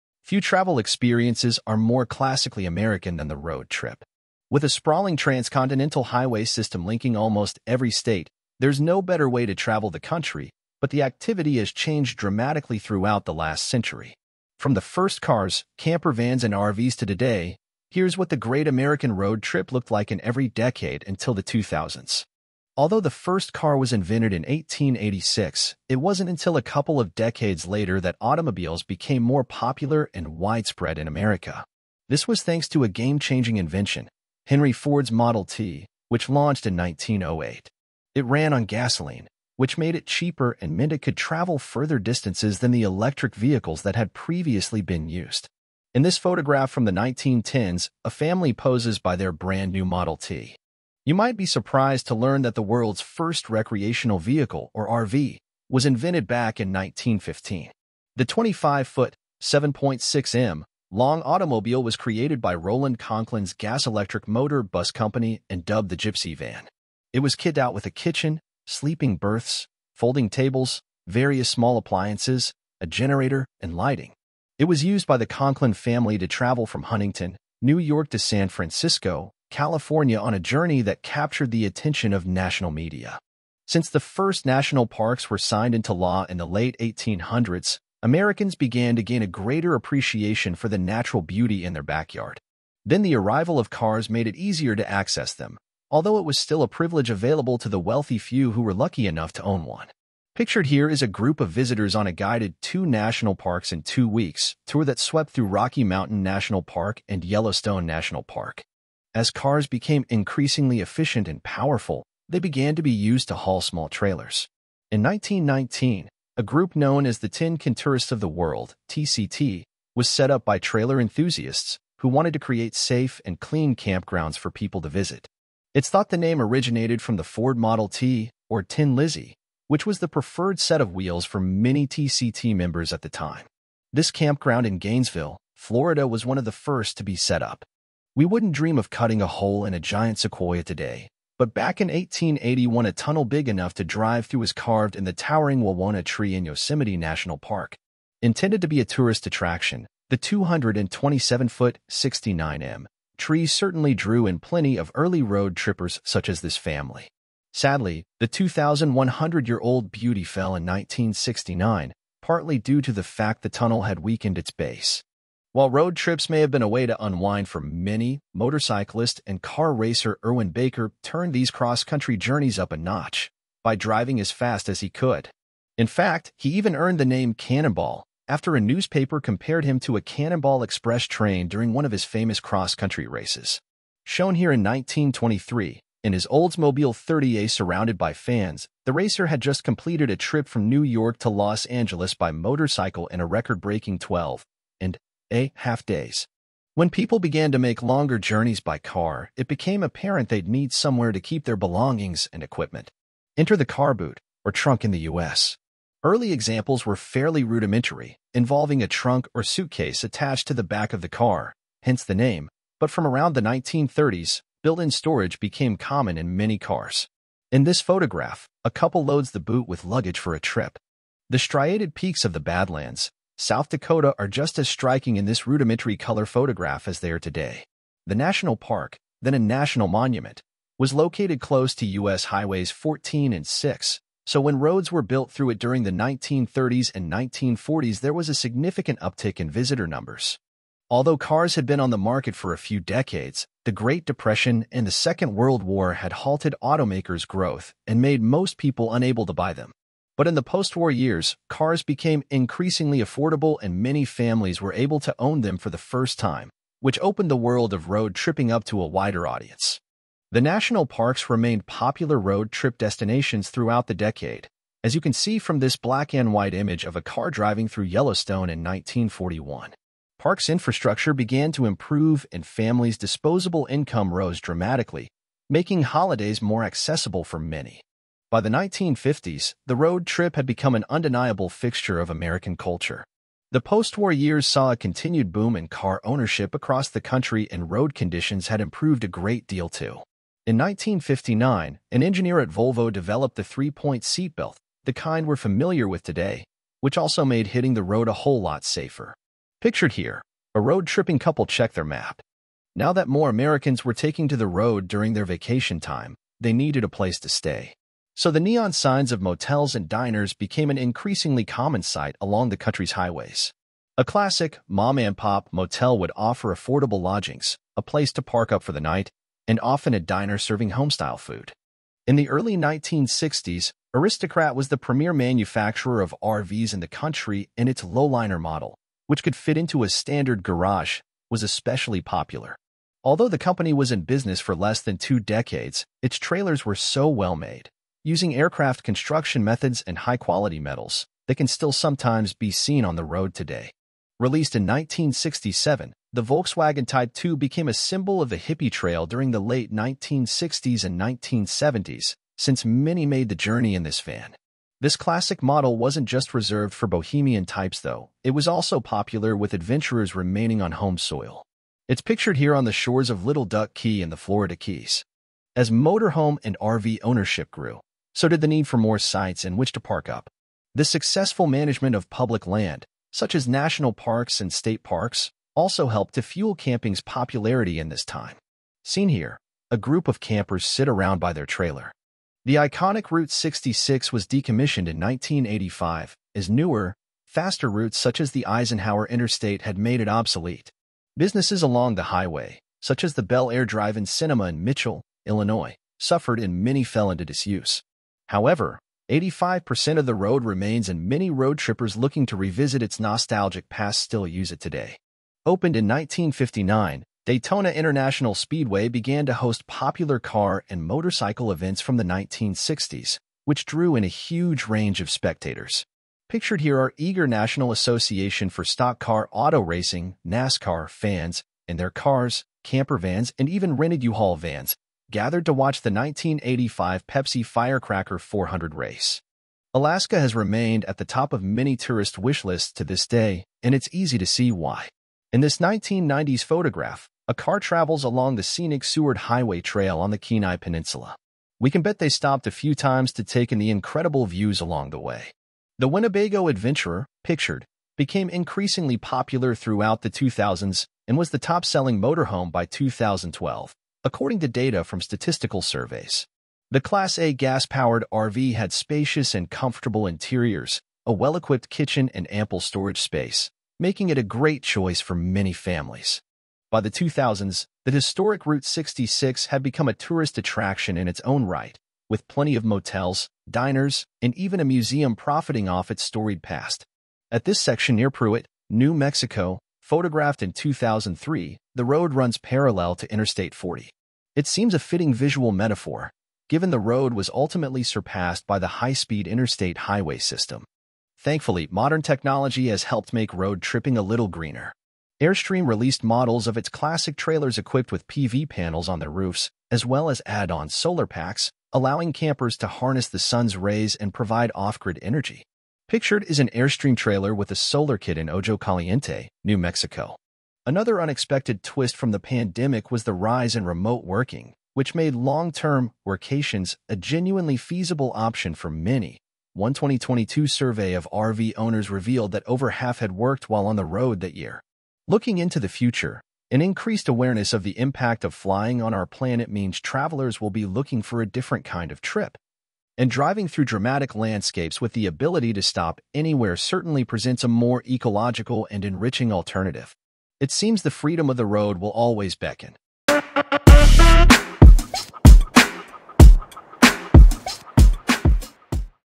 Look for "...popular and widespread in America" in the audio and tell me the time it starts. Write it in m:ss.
0:29.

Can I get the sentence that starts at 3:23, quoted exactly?
Enter the car boot, or trunk in the U.S.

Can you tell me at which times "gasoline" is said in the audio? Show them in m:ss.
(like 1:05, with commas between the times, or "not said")
0:38.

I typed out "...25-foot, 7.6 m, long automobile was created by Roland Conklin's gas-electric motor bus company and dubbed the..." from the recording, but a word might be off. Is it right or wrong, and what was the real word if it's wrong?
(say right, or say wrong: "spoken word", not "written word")
right.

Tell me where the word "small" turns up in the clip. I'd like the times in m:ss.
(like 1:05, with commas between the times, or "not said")
1:11, 1:53.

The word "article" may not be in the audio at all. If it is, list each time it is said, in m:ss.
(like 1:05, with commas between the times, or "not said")
not said.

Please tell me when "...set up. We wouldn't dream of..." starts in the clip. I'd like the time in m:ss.
2:17.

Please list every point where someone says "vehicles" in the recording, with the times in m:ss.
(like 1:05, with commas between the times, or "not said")
0:43, 0:54.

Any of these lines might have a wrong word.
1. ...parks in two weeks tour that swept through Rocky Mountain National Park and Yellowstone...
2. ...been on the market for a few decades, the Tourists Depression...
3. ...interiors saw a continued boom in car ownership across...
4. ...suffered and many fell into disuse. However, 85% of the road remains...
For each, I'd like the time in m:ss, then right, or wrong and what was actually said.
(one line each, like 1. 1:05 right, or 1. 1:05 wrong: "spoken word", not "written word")
1. 1:43 right
2. 4:01 wrong: "Great", not "Tourists"
3. 4:44 wrong: "years", not "interiors"
4. 6:35 right.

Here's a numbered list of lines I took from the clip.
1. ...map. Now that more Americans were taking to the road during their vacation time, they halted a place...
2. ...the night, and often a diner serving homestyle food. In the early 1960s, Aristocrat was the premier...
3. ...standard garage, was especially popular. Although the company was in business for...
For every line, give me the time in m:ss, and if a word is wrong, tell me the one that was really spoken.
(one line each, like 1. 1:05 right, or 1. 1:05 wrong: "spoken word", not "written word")
1. 5:01 wrong: "needed", not "halted"
2. 5:18 right
3. 5:29 right.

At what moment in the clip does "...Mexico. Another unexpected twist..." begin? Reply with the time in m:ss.
8:29.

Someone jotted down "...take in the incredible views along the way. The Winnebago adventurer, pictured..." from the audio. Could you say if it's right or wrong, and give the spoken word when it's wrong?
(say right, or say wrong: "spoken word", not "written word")
right.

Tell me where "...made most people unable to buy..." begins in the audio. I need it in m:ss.
4:07.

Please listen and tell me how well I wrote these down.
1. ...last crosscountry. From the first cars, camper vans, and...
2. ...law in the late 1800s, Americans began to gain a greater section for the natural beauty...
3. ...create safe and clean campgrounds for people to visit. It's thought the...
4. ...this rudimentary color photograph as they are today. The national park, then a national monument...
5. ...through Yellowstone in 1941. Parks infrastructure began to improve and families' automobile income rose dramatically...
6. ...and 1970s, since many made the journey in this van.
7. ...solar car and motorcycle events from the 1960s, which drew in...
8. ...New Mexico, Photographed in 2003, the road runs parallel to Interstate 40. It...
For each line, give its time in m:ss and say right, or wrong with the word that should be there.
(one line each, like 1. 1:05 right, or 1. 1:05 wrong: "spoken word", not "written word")
1. 0:13 wrong: "century", not "crosscountry"
2. 1:25 wrong: "appreciation", not "section"
3. 2:02 right
4. 3:45 right
5. 4:27 wrong: "disposable", not "automobile"
6. 5:50 right
7. 6:49 wrong: "popular", not "solar"
8. 7:58 right.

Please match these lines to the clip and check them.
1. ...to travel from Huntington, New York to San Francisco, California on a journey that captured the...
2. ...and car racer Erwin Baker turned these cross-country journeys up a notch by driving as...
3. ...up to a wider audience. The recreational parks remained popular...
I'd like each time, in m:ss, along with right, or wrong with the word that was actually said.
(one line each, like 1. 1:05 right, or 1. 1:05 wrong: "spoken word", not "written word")
1. 1:16 right
2. 2:49 right
3. 4:18 wrong: "national", not "recreational".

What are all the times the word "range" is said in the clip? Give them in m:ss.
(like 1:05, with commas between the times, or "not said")
6:54.